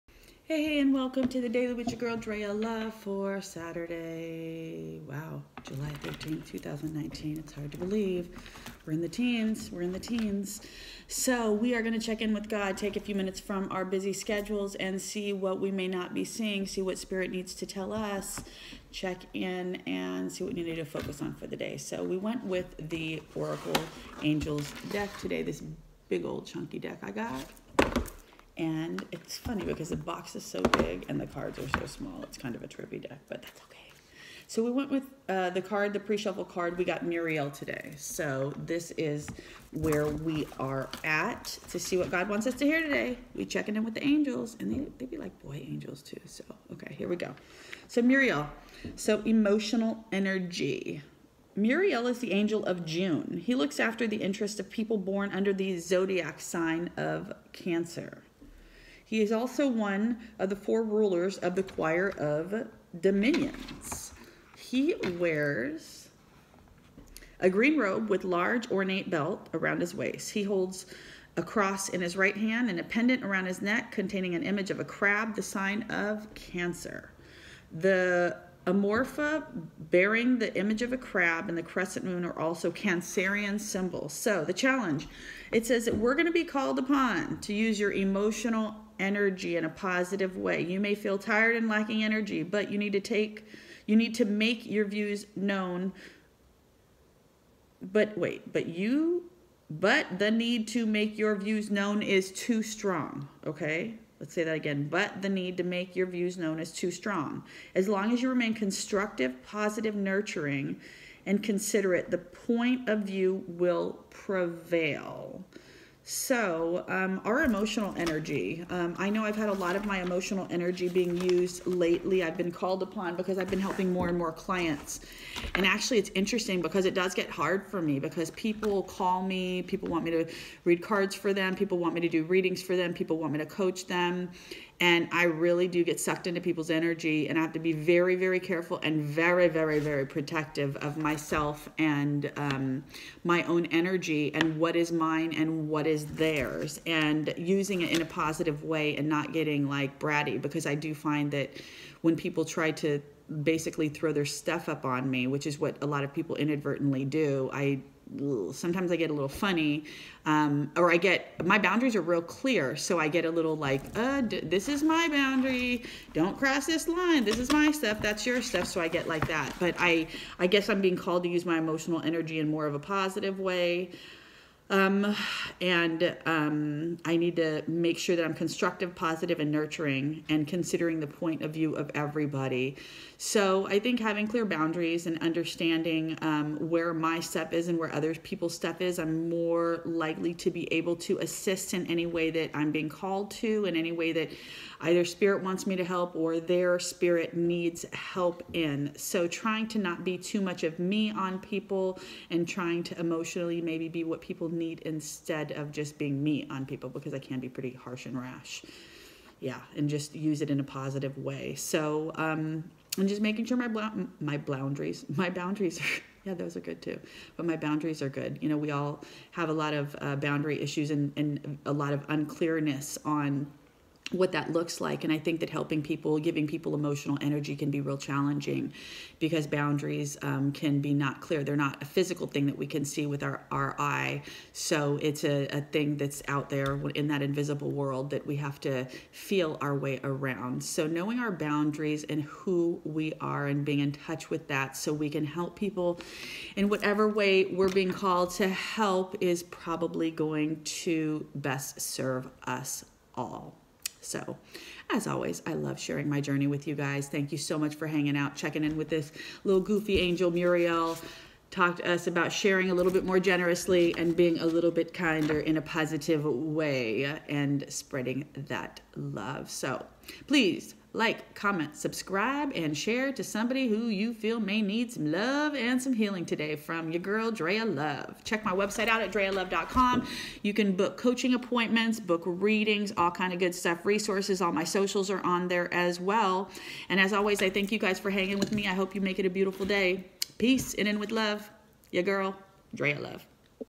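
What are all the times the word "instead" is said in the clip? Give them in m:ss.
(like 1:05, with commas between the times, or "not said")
3:24.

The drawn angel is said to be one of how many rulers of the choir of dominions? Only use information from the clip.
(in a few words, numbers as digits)
4.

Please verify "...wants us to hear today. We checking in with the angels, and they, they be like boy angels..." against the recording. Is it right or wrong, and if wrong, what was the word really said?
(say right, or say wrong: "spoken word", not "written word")
right.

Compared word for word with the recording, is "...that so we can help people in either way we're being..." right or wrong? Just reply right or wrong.
wrong.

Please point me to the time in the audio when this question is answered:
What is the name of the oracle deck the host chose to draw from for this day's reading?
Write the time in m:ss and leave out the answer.
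0:23.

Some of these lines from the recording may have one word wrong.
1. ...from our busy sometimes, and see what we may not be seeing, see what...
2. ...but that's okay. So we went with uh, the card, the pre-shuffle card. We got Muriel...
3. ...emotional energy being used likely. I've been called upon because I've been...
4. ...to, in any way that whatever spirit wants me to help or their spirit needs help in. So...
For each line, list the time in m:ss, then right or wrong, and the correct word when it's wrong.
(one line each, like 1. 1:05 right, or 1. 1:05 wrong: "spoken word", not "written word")
1. 0:13 wrong: "schedules", not "sometimes"
2. 0:33 right
3. 2:00 wrong: "lately", not "likely"
4. 3:13 wrong: "either", not "whatever".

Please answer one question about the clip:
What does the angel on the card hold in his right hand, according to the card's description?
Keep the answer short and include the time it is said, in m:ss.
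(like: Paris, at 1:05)
A cross, at 1:11.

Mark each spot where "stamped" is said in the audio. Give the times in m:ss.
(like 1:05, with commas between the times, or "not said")
not said.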